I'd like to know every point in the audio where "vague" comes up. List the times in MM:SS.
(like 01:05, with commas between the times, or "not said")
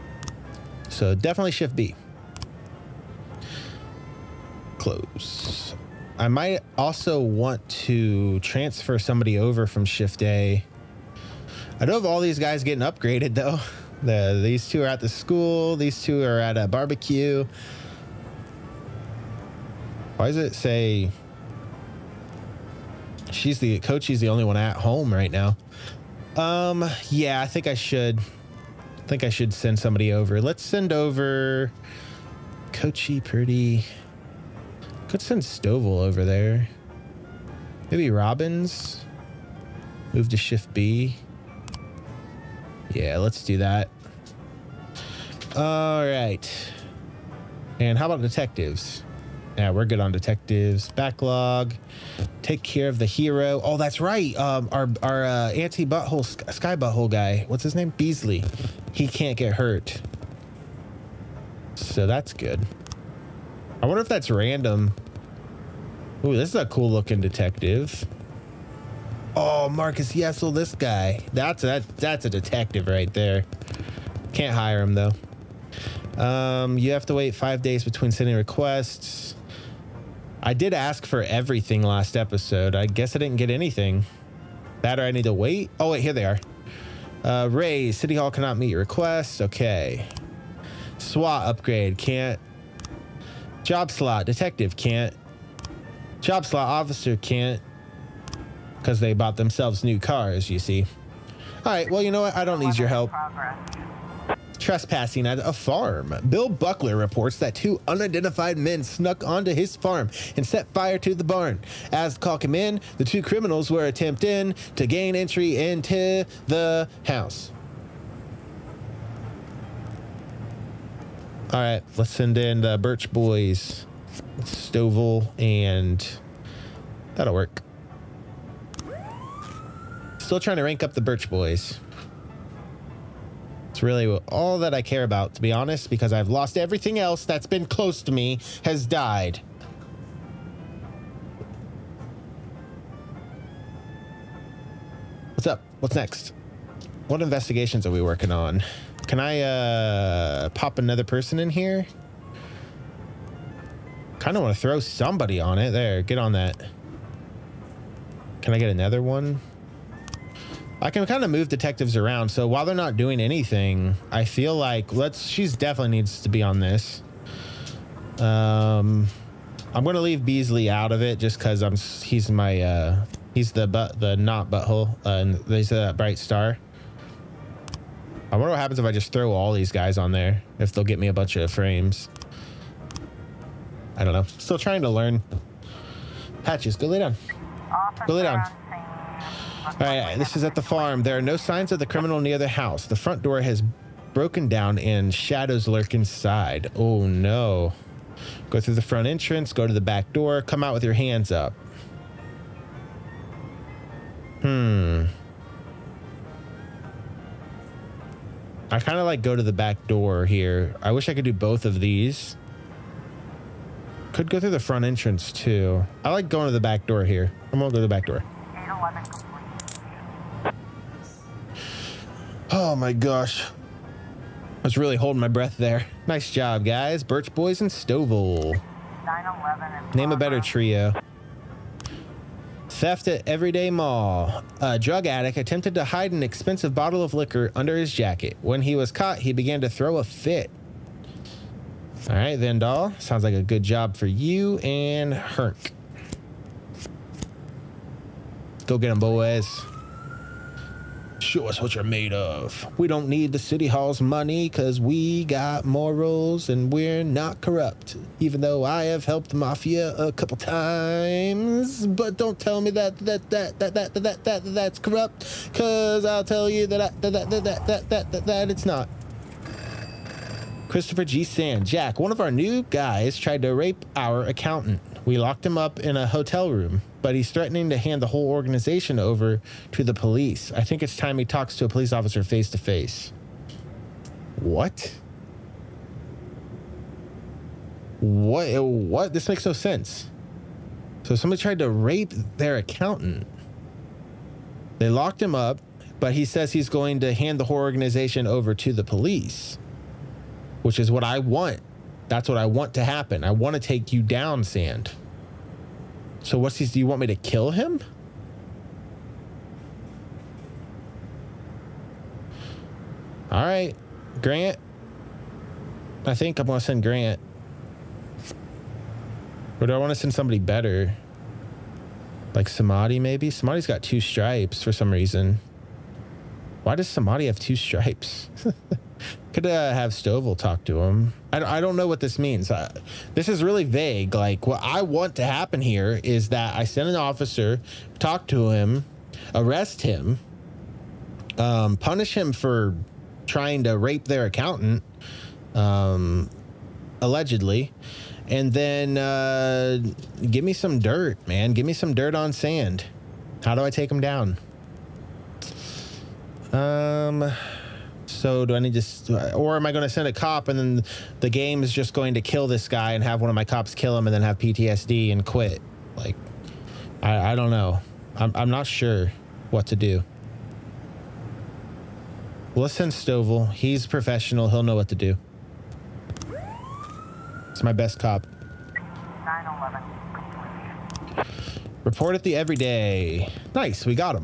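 05:33.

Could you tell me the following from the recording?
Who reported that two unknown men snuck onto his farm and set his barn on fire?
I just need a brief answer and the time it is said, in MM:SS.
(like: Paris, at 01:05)
Bill Buckler, at 01:46.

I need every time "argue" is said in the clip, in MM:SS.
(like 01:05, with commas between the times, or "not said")
not said.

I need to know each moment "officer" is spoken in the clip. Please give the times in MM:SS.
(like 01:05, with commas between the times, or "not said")
01:36, 03:07, 04:41, 05:36.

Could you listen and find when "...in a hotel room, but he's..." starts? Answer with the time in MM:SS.
04:35.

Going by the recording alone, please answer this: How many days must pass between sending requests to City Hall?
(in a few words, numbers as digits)
5.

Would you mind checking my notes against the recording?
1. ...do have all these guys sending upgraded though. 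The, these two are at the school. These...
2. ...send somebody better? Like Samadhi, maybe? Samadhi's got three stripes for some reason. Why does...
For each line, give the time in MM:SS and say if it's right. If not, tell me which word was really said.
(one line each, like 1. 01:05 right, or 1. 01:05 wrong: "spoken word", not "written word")
1. 00:11 wrong: "getting", not "sending"
2. 05:19 wrong: "two", not "three".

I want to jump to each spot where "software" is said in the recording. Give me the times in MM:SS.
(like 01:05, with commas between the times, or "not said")
not said.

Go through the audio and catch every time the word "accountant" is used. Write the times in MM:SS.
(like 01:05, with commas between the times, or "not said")
04:34, 04:52, 05:44.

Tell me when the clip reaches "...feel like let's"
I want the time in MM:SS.
02:44.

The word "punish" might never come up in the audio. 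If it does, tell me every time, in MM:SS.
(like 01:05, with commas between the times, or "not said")
05:41.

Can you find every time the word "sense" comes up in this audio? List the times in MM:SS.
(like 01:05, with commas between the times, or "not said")
04:49.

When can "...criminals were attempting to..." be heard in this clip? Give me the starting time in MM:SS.
01:53.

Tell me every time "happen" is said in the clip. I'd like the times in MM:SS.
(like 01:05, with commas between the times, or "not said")
02:58, 05:02, 05:35.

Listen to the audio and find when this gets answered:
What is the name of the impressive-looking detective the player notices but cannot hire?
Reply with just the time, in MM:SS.
01:09.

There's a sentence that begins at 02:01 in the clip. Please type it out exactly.
All right, let's send in the Birch Boys, Stovall, and that'll work.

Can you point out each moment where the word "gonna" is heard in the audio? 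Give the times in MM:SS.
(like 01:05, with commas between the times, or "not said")
02:49, 03:37.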